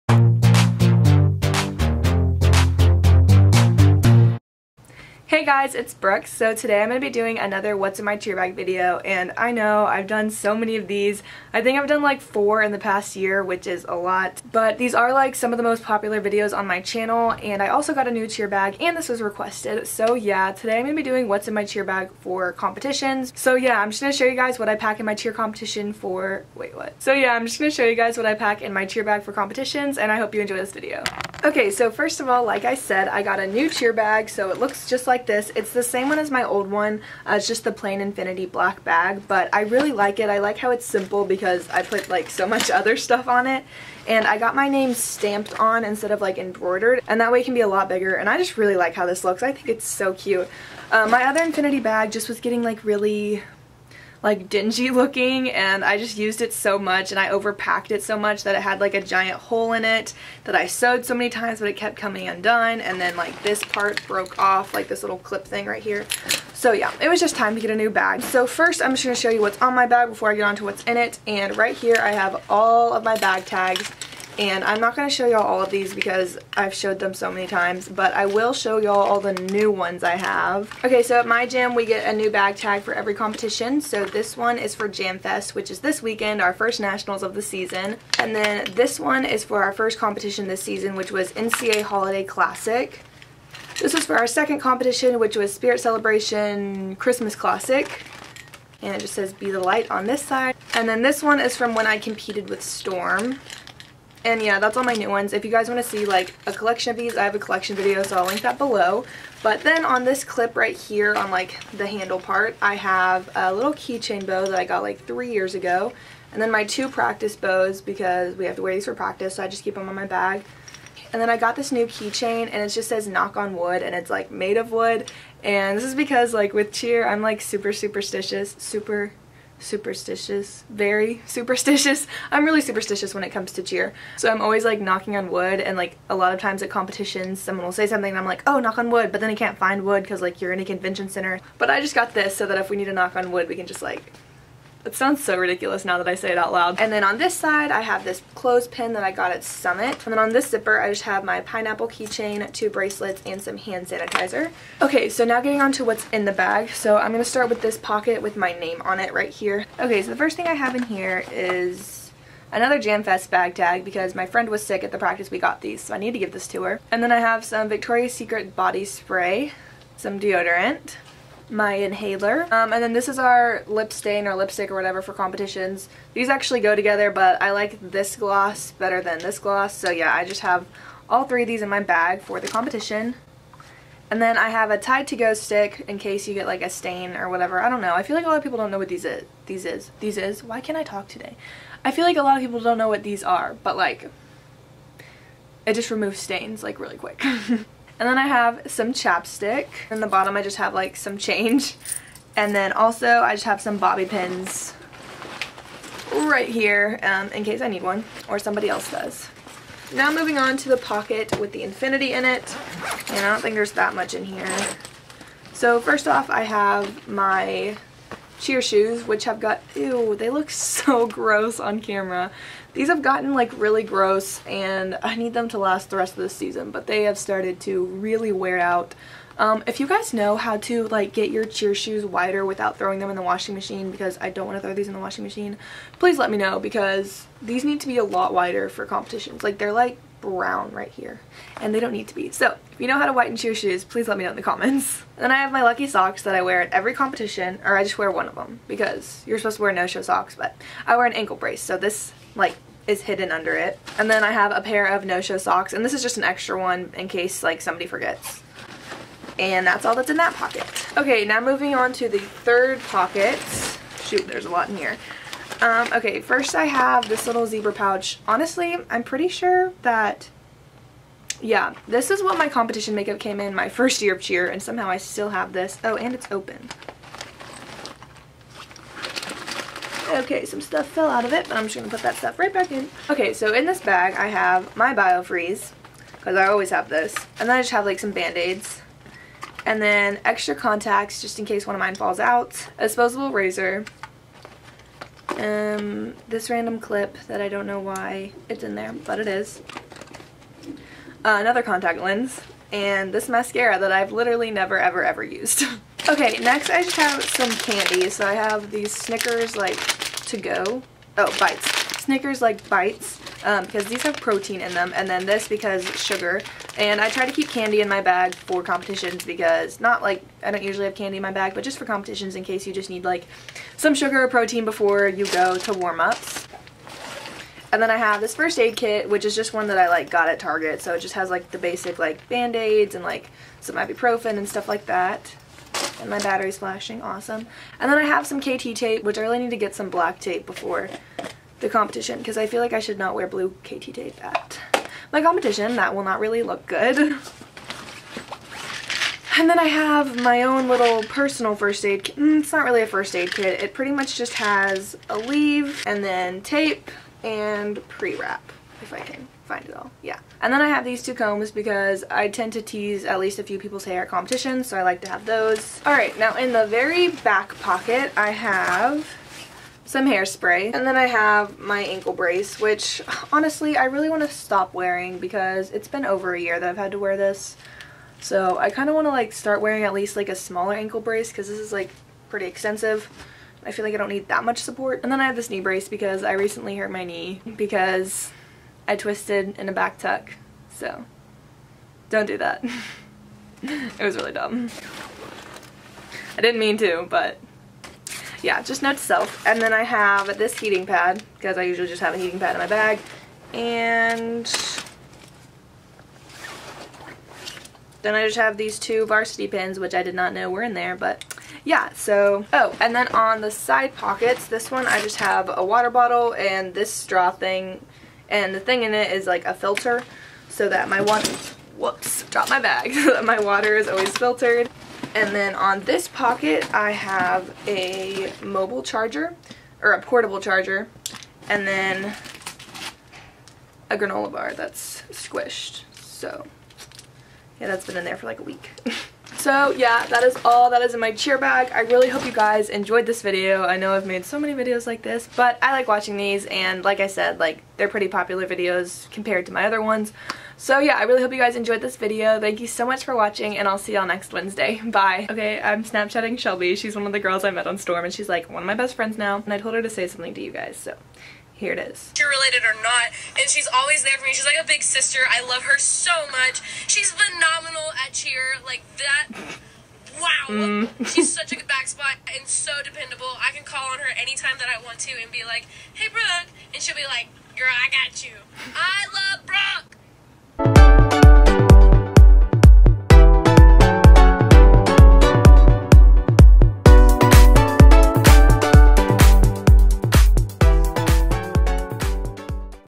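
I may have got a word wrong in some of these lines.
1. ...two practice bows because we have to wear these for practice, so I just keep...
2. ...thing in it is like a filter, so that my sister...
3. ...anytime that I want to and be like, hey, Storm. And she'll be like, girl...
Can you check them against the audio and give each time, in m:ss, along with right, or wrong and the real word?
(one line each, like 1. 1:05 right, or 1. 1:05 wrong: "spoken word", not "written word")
1. 1:56 right
2. 6:58 wrong: "water", not "sister"
3. 7:54 wrong: "Brooke", not "Storm".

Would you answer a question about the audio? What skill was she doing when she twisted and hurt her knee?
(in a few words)
back tuck.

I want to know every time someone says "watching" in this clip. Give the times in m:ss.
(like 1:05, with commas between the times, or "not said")
7:25, 7:33.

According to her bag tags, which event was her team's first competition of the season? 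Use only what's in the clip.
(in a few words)
NCA Holiday Classic.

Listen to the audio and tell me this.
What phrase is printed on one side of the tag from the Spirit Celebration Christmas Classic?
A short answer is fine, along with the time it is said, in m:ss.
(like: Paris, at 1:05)
be the light, at 1:39.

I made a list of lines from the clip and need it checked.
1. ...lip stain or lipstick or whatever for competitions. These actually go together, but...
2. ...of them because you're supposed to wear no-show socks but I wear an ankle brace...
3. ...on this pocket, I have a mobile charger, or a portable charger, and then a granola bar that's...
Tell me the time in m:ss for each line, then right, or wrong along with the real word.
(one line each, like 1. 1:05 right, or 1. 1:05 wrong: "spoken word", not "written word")
1. 2:53 right
2. 4:08 right
3. 7:05 right.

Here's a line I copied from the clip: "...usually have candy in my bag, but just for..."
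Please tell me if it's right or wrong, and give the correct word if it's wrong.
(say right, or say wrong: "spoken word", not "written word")
right.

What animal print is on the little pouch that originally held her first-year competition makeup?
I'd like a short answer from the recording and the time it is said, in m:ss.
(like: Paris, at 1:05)
zebra, at 4:27.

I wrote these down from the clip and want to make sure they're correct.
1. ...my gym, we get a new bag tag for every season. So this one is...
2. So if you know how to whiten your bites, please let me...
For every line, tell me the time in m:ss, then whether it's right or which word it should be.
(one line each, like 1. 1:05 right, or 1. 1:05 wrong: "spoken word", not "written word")
1. 1:21 wrong: "competition", not "season"
2. 4:02 wrong: "shoes", not "bites".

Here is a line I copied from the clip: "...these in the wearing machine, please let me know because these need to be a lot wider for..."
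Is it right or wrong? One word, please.
wrong.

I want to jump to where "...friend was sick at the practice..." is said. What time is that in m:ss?
2:44.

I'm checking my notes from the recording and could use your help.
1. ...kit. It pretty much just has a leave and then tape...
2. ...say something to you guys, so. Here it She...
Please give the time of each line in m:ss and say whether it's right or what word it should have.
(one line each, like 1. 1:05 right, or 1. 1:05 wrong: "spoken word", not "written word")
1. 5:53 right
2. 7:39 right.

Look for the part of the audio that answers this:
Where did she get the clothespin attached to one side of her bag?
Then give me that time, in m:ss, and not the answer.
2:29.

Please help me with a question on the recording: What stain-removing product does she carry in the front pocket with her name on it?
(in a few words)
Tide to Go stick.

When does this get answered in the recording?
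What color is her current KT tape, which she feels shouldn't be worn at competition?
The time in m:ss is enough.
5:43.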